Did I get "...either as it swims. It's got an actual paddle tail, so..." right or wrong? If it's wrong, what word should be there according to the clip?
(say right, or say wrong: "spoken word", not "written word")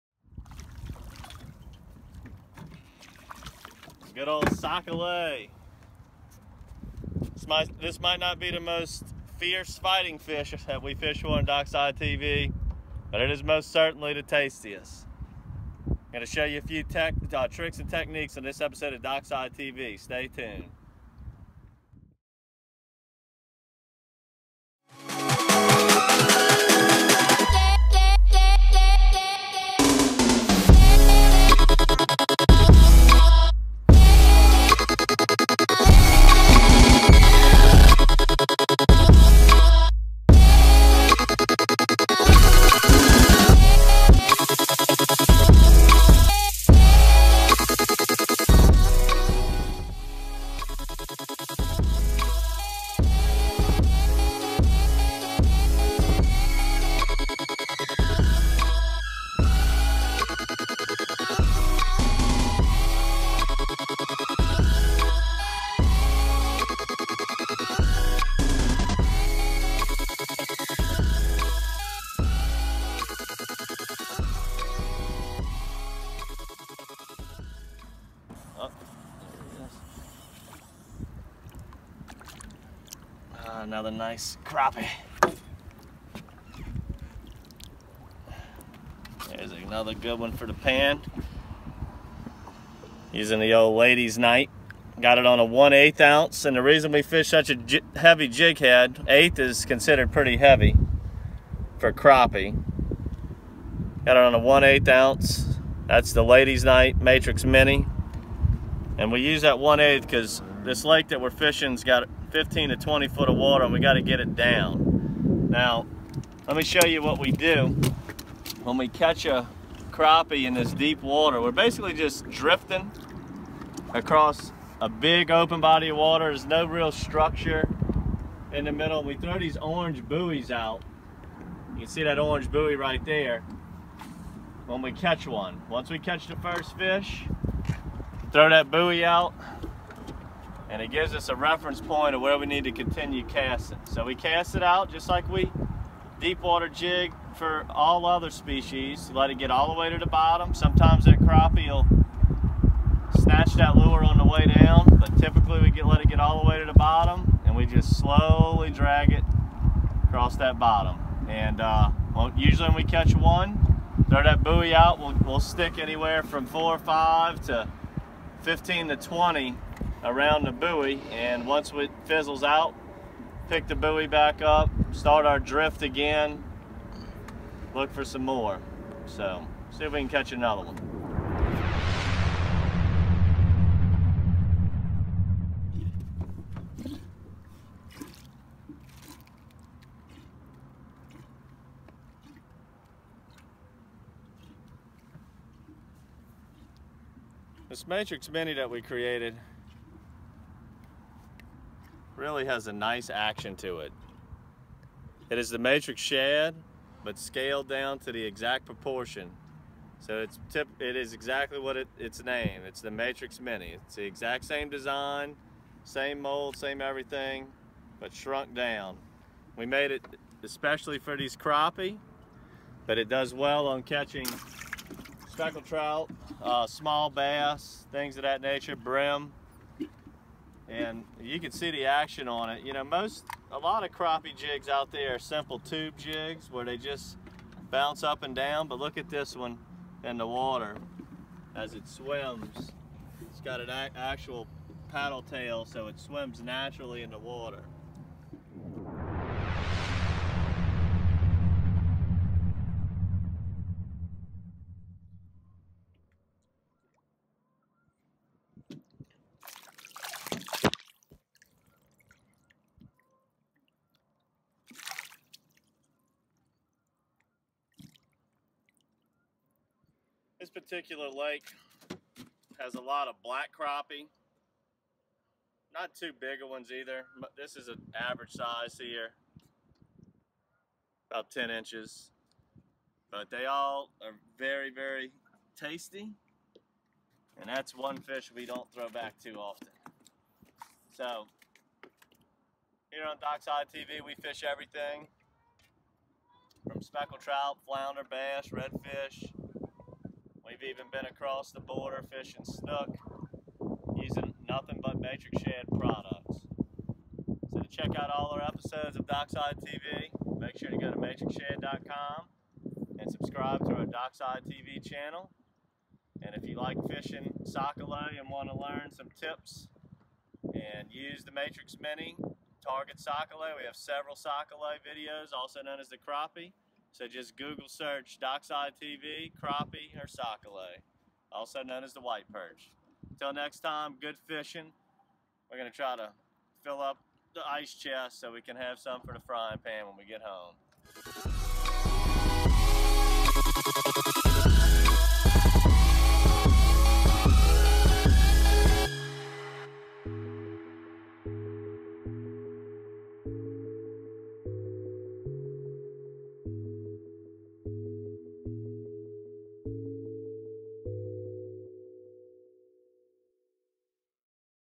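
wrong: "water", not "either".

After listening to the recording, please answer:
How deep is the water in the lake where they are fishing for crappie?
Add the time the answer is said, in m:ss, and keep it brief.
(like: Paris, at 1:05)
15 to 20 feet, at 1:52.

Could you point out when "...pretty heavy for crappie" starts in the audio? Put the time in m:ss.
1:40.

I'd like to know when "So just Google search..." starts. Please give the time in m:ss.
5:26.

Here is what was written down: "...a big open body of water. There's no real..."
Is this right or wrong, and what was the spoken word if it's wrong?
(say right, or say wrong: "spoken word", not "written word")
right.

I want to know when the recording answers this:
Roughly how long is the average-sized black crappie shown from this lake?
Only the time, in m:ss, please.
4:41.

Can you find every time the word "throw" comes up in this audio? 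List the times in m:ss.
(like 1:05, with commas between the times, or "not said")
2:09, 2:18, 2:44, 4:48.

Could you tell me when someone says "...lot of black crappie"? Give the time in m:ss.
4:32.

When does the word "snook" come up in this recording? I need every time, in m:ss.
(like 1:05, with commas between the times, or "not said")
5:02.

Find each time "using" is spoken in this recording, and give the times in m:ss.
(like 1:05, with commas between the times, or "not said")
1:33, 5:03.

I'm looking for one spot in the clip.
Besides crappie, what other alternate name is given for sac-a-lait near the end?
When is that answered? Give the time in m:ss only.
5:32.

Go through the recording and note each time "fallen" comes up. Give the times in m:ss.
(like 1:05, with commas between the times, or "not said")
not said.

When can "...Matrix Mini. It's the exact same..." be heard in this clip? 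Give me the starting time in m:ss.
3:32.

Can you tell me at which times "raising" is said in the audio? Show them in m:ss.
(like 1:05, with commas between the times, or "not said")
not said.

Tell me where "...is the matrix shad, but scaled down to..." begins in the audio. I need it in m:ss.
3:25.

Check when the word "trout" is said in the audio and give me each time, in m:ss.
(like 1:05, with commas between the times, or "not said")
3:45, 4:57.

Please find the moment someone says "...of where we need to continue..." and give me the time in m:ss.
2:22.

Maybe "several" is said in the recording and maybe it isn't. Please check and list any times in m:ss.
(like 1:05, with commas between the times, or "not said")
5:23.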